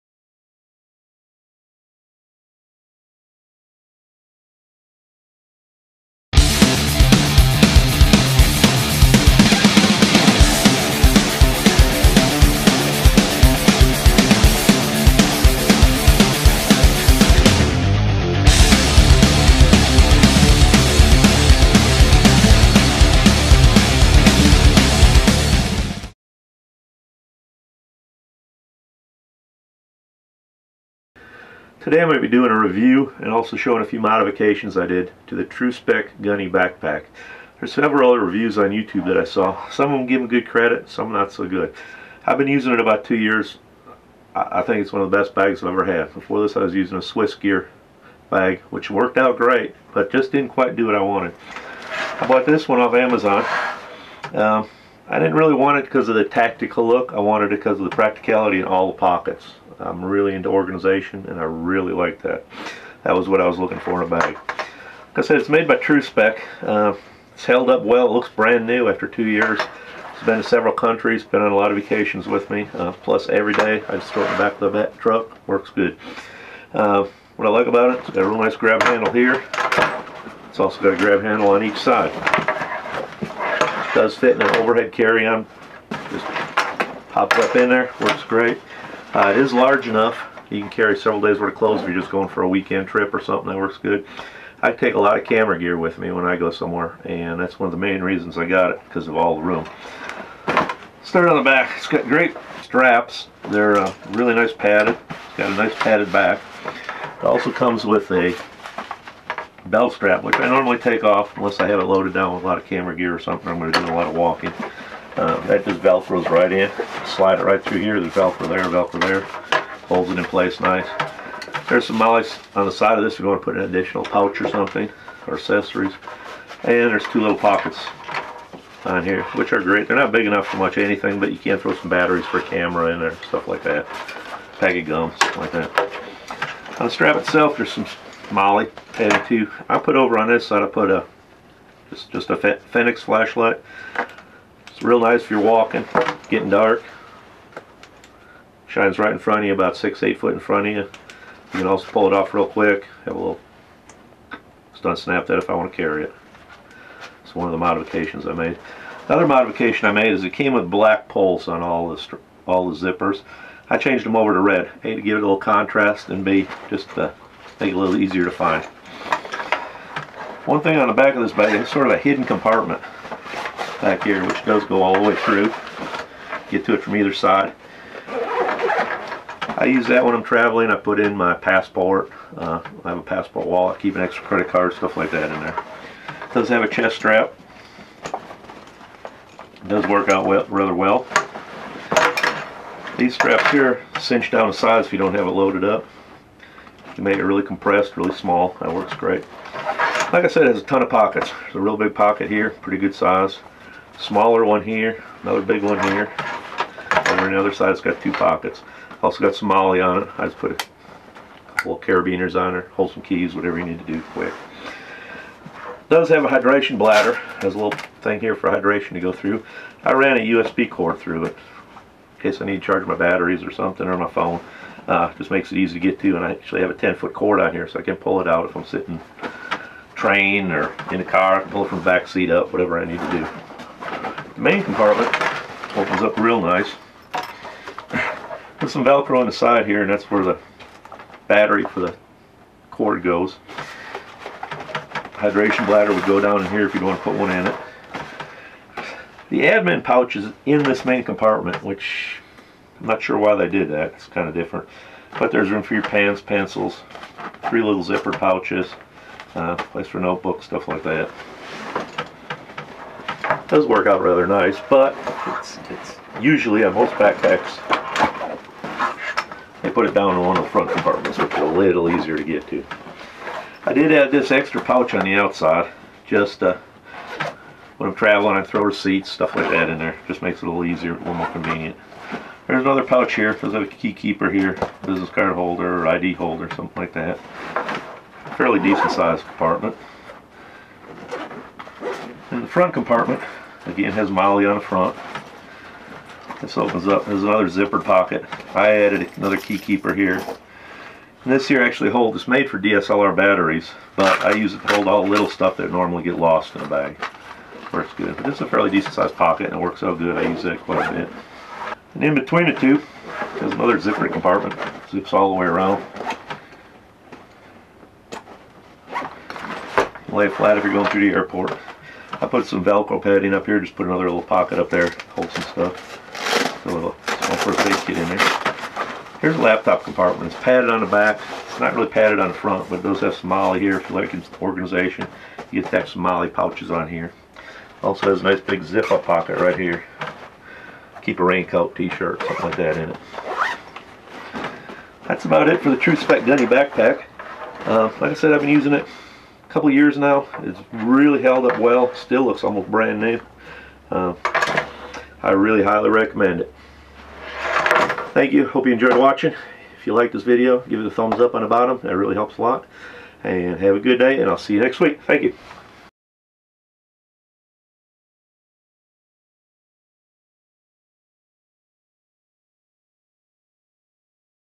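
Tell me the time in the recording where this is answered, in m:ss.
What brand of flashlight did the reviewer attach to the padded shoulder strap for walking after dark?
2:22.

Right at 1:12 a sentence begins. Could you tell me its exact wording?
Uh, plus every day I just throw it in the back of the truck.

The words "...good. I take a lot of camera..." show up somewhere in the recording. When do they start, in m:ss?
1:33.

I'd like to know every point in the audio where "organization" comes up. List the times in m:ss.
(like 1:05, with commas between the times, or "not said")
1:00, 5:34.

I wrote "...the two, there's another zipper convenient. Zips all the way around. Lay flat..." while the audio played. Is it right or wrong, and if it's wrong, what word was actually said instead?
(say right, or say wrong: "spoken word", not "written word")
wrong: "compartment", not "convenient".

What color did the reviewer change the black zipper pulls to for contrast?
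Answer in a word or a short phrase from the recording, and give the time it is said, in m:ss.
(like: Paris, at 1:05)
red, at 2:44.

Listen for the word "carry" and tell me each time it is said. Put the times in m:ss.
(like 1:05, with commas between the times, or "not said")
1:24, 1:30, 2:35.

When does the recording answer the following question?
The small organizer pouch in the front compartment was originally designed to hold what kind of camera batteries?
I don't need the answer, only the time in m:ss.
5:02.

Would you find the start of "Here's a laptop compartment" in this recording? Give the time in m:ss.
5:29.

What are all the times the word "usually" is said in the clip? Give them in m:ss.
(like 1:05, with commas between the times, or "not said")
4:26.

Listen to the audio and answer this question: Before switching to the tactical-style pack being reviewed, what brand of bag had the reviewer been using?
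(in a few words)
Swiss Gear.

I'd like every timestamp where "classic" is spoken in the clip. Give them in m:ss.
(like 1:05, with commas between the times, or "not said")
not said.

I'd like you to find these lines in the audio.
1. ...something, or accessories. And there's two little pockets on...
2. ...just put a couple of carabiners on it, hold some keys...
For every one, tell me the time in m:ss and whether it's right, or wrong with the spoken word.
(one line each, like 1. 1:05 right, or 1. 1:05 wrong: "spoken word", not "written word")
1. 2:04 right
2. 3:30 right.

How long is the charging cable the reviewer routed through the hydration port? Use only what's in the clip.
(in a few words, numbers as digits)
10 feet.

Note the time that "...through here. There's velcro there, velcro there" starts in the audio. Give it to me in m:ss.
1:57.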